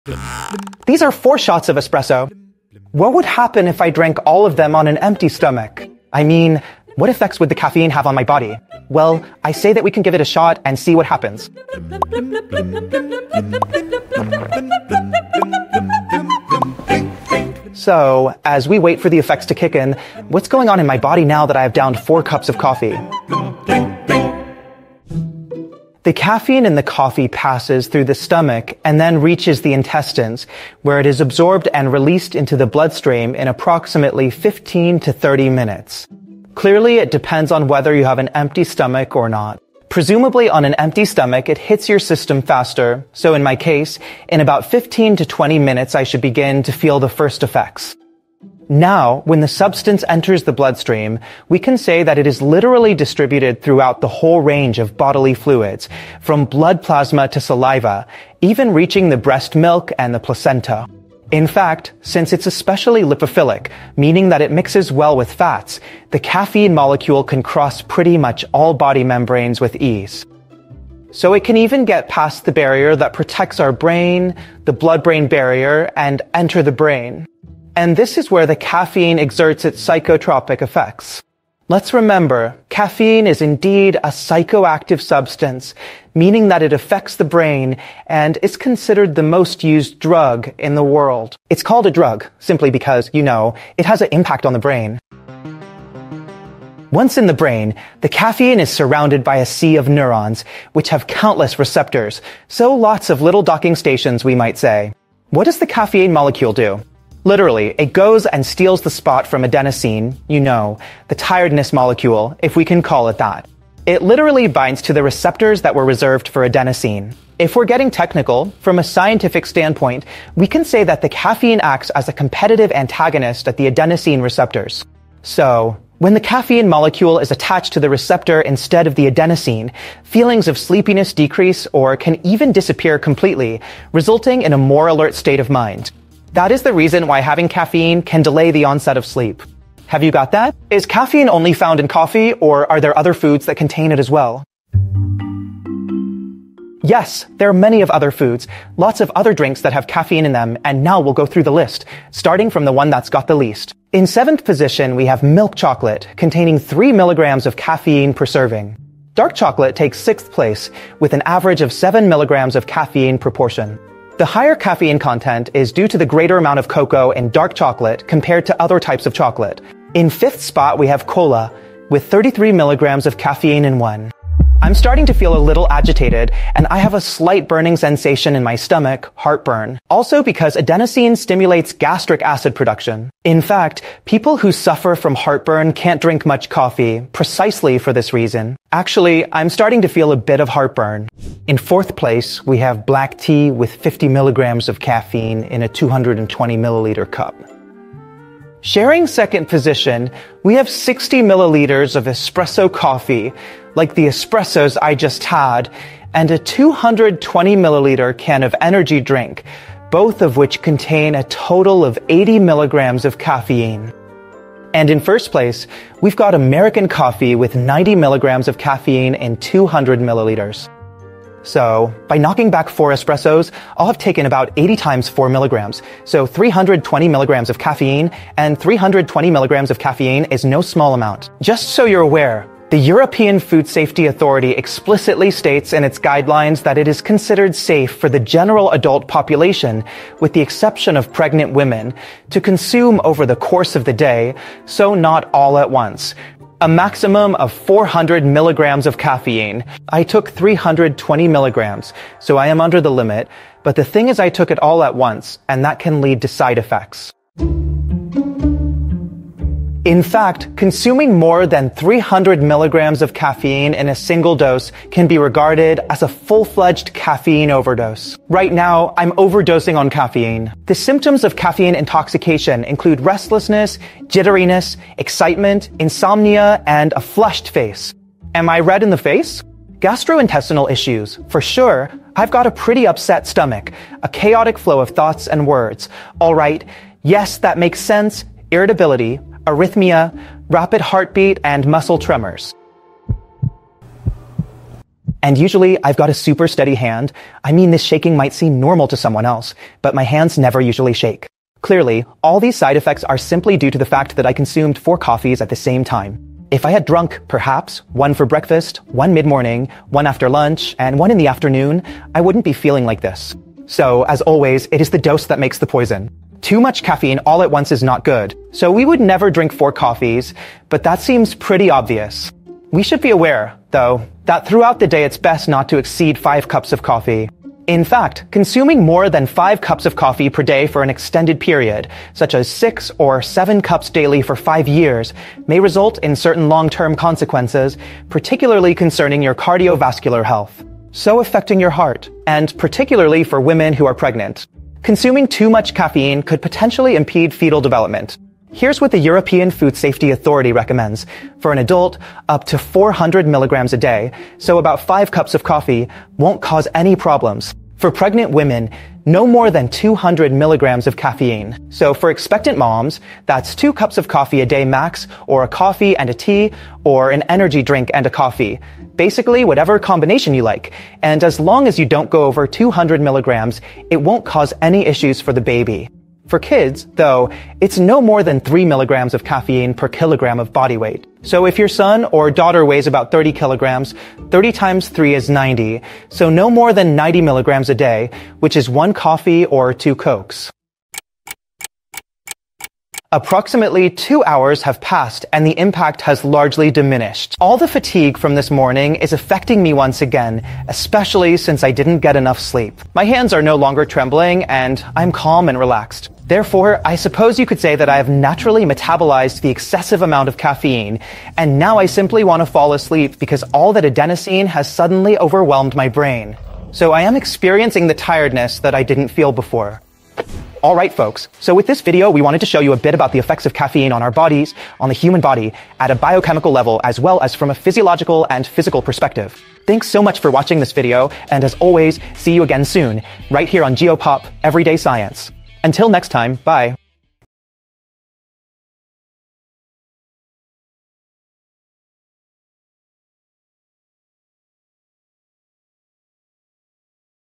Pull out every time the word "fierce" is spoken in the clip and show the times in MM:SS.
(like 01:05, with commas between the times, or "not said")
not said.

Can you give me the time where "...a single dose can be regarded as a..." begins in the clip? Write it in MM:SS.
04:23.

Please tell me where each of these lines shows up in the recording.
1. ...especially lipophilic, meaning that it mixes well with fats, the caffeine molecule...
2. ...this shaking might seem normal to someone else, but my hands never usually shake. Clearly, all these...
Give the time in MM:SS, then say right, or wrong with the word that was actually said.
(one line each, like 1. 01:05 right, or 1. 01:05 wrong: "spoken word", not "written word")
1. 01:02 right
2. 04:57 right.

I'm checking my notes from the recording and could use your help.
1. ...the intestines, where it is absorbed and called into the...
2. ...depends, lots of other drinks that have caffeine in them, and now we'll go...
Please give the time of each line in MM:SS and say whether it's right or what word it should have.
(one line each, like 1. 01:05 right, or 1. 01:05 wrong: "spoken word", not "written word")
1. 00:29 wrong: "released", not "called"
2. 02:28 wrong: "foods", not "depends".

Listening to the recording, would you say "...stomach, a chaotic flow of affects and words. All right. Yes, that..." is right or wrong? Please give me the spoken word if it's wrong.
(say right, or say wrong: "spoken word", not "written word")
wrong: "thoughts", not "affects".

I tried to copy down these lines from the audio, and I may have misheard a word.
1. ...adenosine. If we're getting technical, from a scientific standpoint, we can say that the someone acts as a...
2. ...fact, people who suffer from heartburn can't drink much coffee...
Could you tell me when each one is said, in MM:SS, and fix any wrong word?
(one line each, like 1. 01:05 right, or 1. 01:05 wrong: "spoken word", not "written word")
1. 01:56 wrong: "caffeine", not "someone"
2. 03:03 right.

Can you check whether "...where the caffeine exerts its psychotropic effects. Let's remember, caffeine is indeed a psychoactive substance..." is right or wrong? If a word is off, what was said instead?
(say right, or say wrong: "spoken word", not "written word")
right.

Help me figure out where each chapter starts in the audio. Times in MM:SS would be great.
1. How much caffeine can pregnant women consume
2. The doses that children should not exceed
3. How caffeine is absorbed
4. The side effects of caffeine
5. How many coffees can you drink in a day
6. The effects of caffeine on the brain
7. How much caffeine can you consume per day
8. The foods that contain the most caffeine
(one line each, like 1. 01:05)
1. 06:50
2. 07:09
3. 00:49
4. 05:08
5. 06:19
6. 02:00
7. 04:36
8. 02:54.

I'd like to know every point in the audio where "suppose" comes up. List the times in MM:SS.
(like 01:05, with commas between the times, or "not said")
06:46.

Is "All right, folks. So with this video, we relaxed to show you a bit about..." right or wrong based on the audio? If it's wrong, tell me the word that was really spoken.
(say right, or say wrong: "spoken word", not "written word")
wrong: "wanted", not "relaxed".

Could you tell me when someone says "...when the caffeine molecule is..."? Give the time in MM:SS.
02:05.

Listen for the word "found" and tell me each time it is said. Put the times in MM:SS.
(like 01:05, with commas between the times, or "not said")
02:21.